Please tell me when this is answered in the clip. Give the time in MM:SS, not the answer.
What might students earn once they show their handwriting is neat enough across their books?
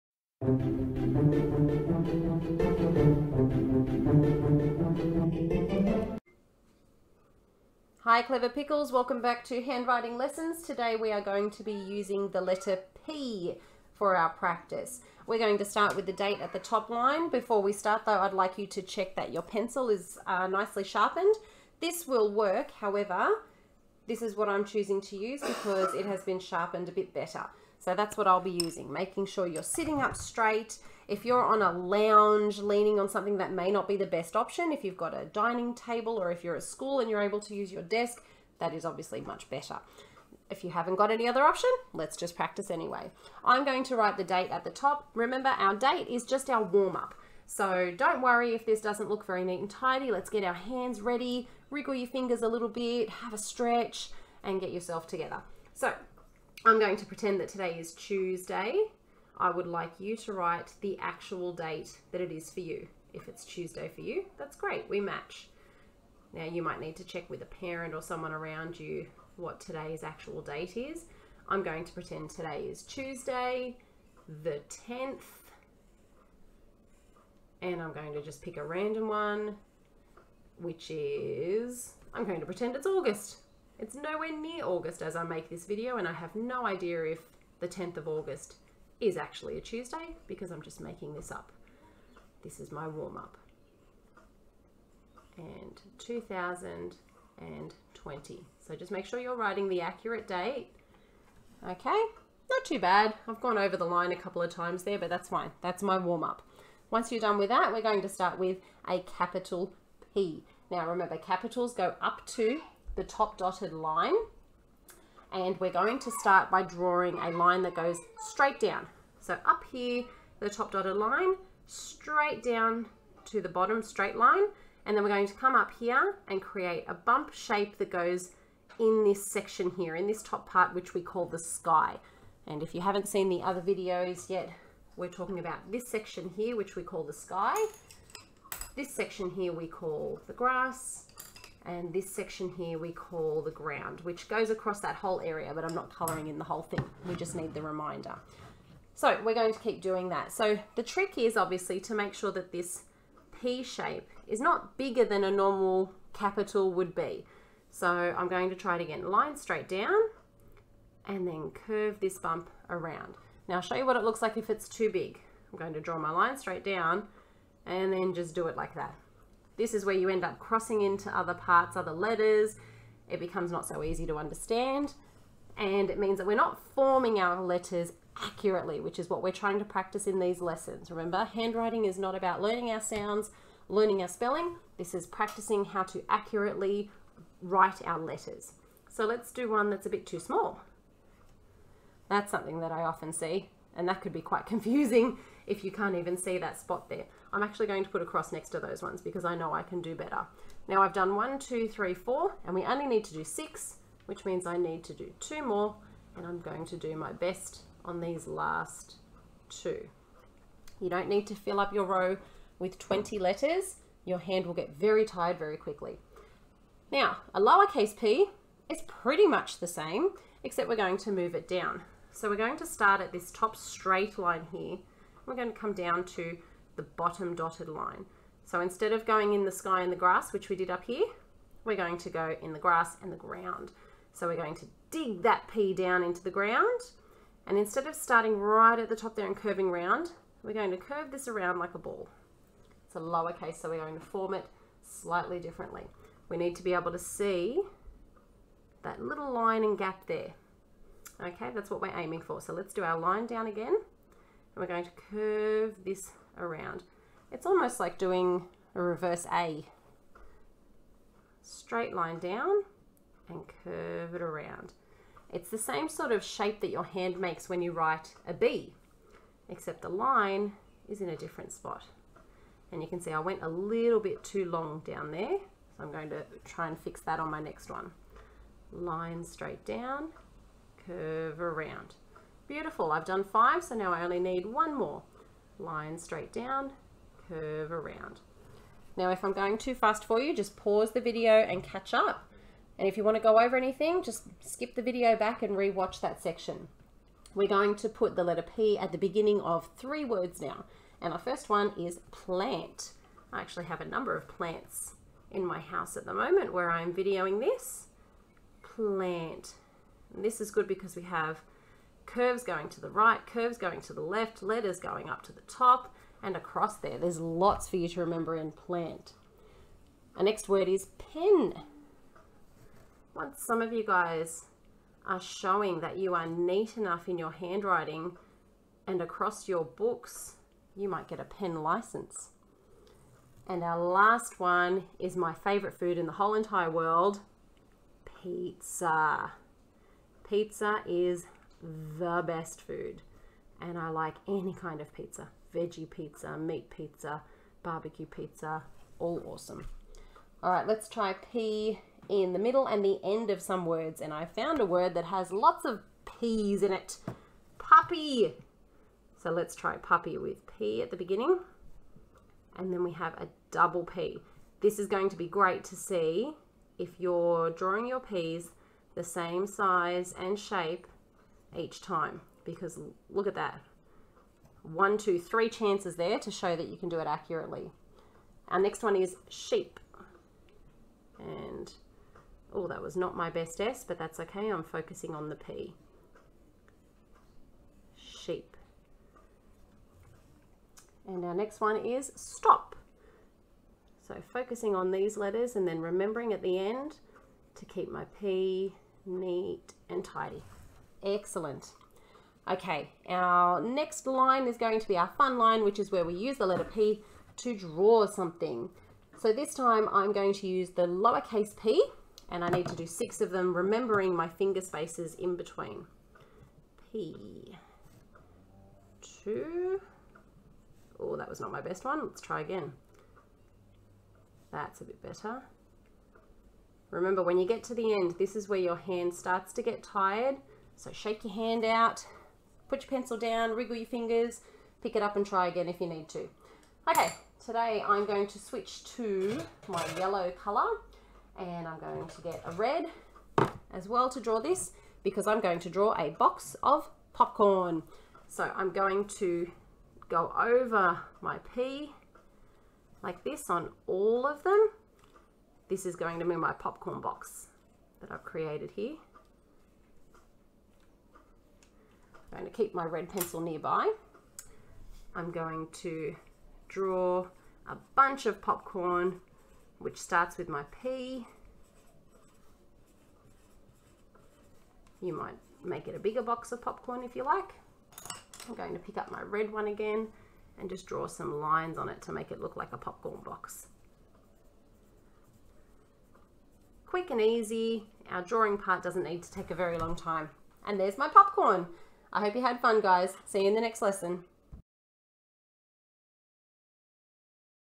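05:31.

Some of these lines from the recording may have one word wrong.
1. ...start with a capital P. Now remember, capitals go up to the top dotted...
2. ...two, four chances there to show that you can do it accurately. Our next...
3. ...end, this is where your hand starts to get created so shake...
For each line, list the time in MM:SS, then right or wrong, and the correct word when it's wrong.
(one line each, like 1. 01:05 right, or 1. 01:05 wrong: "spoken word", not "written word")
1. 01:48 right
2. 06:14 wrong: "three", not "four"
3. 07:07 wrong: "tired", not "created".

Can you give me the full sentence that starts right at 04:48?
Now, if I'm going too fast for you, just pause the video and catch up.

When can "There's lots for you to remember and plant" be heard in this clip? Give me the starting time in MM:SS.
05:16.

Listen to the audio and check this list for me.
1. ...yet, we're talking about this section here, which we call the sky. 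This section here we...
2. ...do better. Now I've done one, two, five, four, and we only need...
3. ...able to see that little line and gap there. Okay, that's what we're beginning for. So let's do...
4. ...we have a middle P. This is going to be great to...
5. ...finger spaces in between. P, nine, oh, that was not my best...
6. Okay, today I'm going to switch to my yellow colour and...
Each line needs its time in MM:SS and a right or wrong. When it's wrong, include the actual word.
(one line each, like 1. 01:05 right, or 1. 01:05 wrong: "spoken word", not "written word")
1. 02:14 right
2. 03:19 wrong: "three", not "five"
3. 04:06 wrong: "aiming", not "beginning"
4. 06:02 wrong: "double", not "middle"
5. 06:54 wrong: "two", not "nine"
6. 07:16 right.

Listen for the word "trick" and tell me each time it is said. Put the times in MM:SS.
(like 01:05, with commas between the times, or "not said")
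02:30.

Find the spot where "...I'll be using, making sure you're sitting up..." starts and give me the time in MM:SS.
00:28.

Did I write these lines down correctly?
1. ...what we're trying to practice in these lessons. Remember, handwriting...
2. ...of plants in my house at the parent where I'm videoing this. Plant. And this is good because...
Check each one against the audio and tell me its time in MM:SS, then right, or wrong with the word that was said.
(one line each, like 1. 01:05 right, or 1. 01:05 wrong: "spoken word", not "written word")
1. 02:59 right
2. 05:04 wrong: "moment", not "parent".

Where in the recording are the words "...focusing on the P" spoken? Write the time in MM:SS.
06:24.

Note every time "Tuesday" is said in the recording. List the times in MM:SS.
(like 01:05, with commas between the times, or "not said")
00:57, 01:03, 01:12, 01:29.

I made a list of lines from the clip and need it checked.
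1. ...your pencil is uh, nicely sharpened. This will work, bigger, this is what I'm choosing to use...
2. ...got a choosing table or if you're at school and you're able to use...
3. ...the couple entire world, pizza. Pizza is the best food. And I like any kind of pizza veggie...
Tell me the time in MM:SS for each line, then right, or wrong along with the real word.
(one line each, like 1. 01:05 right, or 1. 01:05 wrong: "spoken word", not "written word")
1. 00:19 wrong: "however", not "bigger"
2. 00:34 wrong: "dining", not "choosing"
3. 05:36 wrong: "whole", not "couple".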